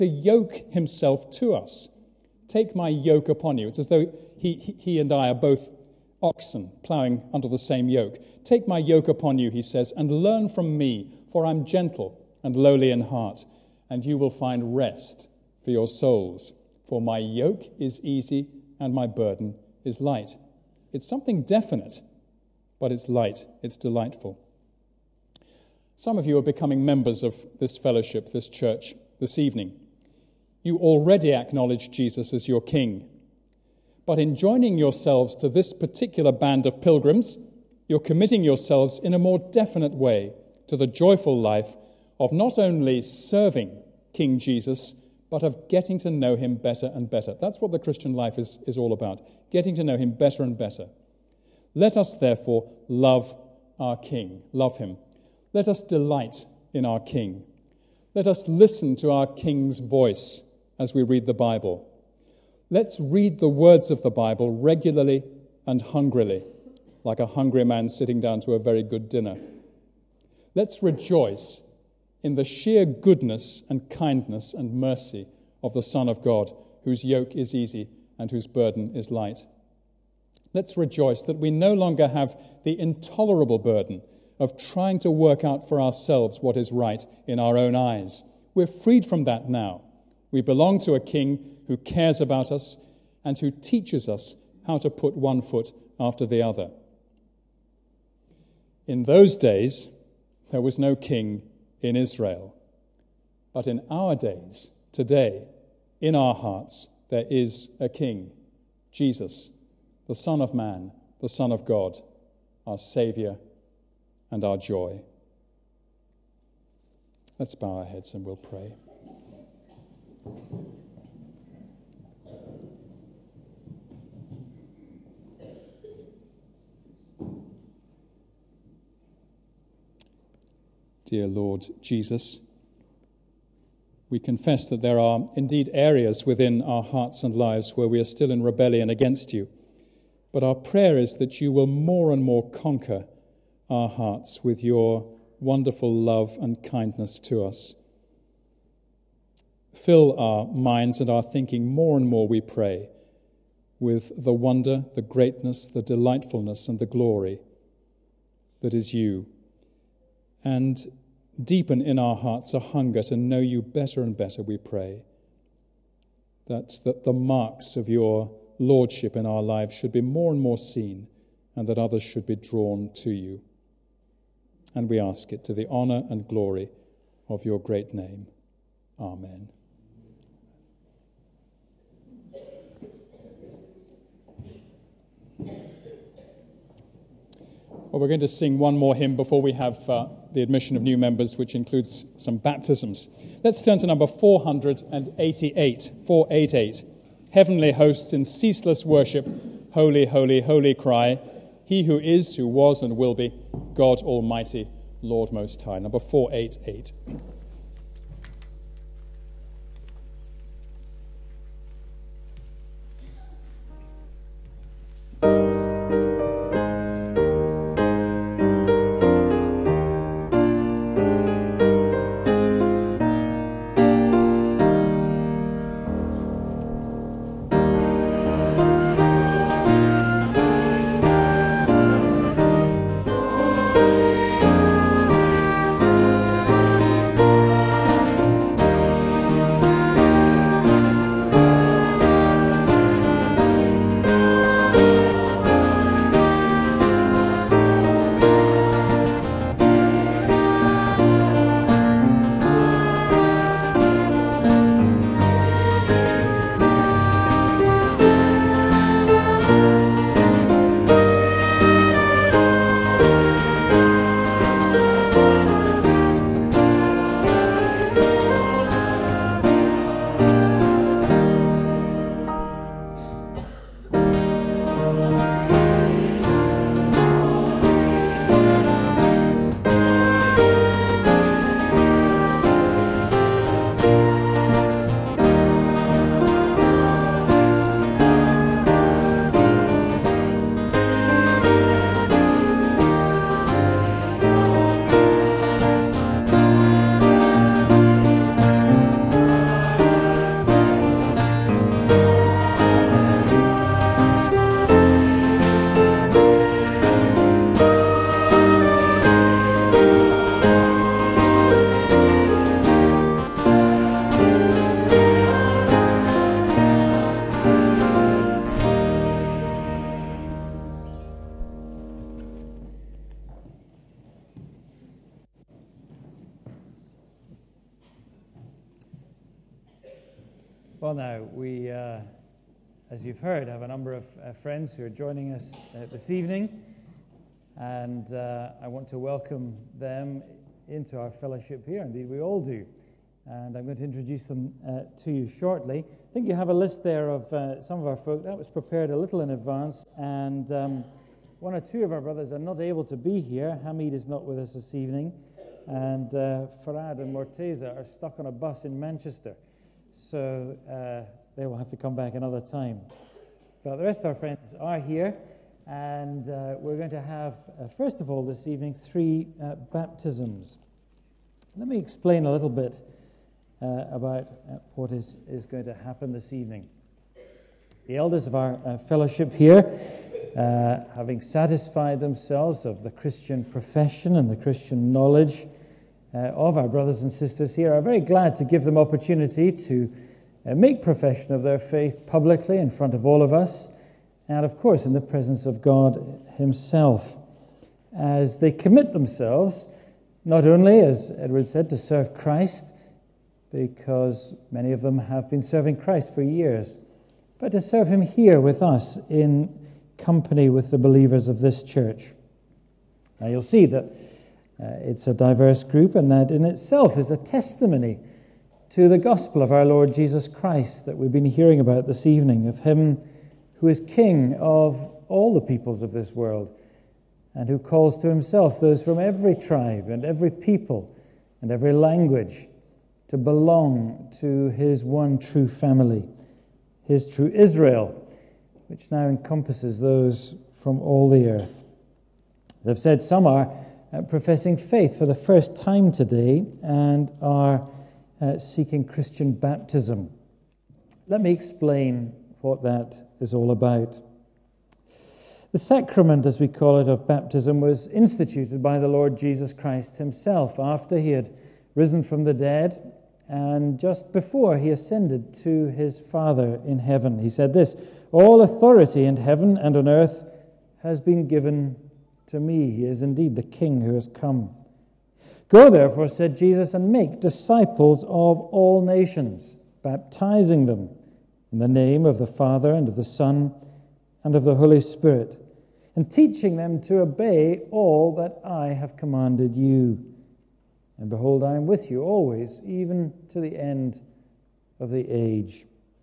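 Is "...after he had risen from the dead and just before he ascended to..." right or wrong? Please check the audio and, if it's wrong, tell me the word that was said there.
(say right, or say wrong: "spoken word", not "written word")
right.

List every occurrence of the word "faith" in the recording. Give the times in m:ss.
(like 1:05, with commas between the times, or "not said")
6:31, 7:24.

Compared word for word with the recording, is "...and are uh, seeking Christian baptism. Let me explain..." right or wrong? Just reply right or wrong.
right.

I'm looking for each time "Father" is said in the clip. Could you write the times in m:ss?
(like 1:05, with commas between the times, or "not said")
7:45, 8:02.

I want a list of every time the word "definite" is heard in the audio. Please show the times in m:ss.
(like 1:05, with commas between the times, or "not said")
0:21, 0:39.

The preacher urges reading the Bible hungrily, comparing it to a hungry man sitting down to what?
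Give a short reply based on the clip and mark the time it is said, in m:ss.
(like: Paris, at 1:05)
A very good dinner, at 1:08.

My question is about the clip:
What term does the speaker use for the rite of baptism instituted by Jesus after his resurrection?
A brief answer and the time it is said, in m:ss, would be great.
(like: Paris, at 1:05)
Sacrament, at 7:35.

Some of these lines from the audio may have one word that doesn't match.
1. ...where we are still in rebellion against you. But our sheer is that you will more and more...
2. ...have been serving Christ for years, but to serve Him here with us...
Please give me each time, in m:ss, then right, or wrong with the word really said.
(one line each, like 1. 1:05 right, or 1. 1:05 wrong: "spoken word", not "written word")
1. 2:17 wrong: "prayer", not "sheer"
2. 6:44 right.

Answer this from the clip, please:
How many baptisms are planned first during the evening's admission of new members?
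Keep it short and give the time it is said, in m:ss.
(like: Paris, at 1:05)
3, at 6:08.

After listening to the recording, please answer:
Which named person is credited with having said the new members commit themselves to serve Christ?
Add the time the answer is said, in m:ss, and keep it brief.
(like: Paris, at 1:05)
Edward, at 6:41.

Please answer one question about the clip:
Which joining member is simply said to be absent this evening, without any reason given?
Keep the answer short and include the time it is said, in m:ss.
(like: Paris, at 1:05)
Hamid, at 5:53.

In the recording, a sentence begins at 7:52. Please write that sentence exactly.
He is indeed the King who has come.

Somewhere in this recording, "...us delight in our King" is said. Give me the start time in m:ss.
0:55.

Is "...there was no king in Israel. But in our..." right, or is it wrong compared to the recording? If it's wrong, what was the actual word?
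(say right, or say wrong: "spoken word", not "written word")
right.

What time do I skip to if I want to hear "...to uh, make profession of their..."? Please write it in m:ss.
6:29.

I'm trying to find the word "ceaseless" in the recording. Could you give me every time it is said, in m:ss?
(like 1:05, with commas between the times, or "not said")
3:18.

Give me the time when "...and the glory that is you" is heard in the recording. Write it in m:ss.
2:36.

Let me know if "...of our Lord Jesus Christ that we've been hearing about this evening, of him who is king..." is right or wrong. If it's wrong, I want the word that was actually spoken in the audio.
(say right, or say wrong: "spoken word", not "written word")
right.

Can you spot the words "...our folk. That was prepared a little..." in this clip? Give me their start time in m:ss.
5:47.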